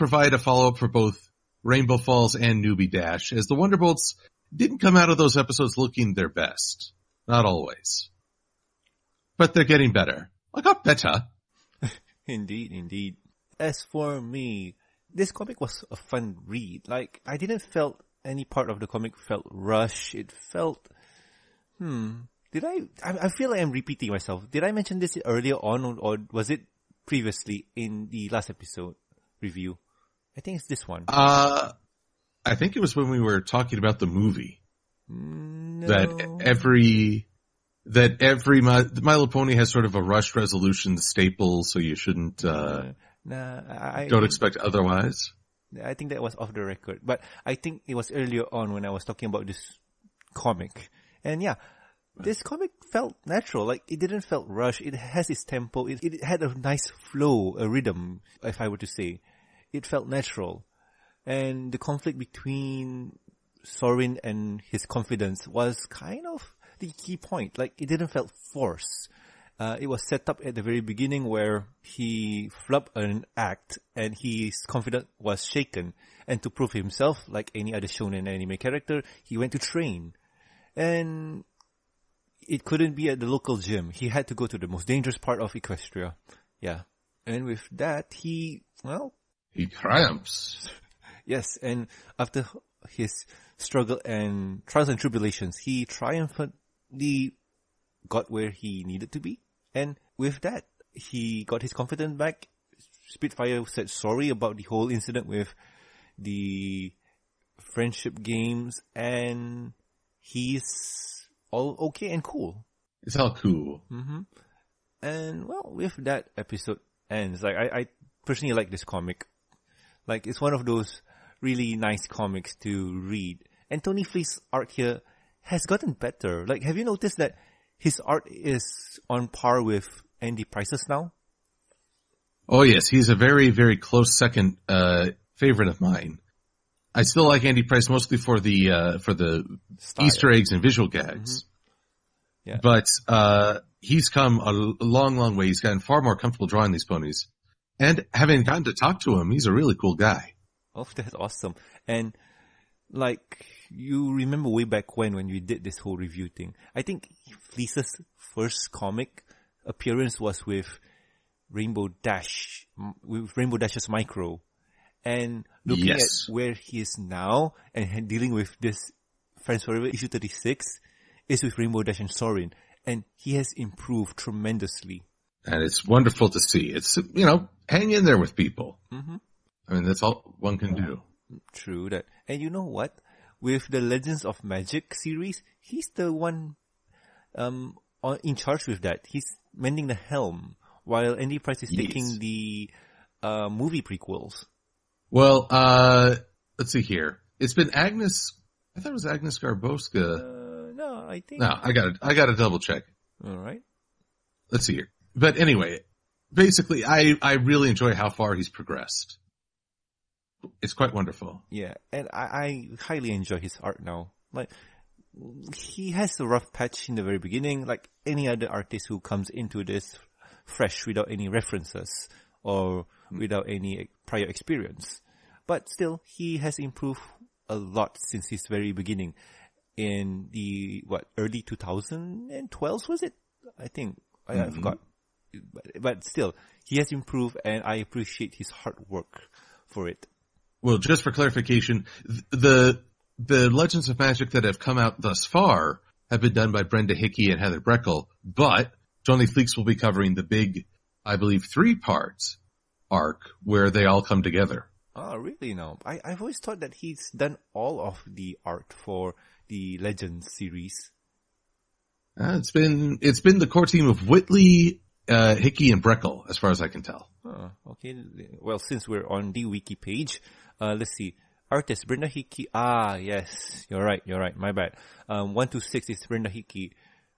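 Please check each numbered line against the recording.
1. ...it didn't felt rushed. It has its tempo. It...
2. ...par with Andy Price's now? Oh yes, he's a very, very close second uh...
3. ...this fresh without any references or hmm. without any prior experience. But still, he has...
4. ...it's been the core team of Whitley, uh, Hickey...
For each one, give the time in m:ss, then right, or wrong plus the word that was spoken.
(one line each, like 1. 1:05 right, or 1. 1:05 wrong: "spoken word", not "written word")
1. 0:53 right
2. 2:09 right
3. 3:39 right
4. 4:23 right.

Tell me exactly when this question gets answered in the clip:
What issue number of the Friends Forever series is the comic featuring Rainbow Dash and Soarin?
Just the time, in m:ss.
2:50.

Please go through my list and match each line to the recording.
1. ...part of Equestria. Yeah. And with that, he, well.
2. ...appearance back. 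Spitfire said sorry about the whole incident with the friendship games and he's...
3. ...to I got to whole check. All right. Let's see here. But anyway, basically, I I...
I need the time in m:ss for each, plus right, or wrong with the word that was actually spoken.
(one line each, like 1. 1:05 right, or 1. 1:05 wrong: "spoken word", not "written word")
1. 1:25 right
2. 1:41 wrong: "confidence", not "appearance"
3. 3:21 wrong: "double", not "whole".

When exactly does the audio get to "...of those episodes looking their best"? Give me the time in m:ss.
0:05.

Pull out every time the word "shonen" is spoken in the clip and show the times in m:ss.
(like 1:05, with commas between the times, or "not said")
1:17.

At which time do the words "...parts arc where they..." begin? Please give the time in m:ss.
4:11.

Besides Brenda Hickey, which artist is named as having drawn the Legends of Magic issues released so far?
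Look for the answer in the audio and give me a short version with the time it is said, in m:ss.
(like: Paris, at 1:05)
Heather Breckel, at 4:07.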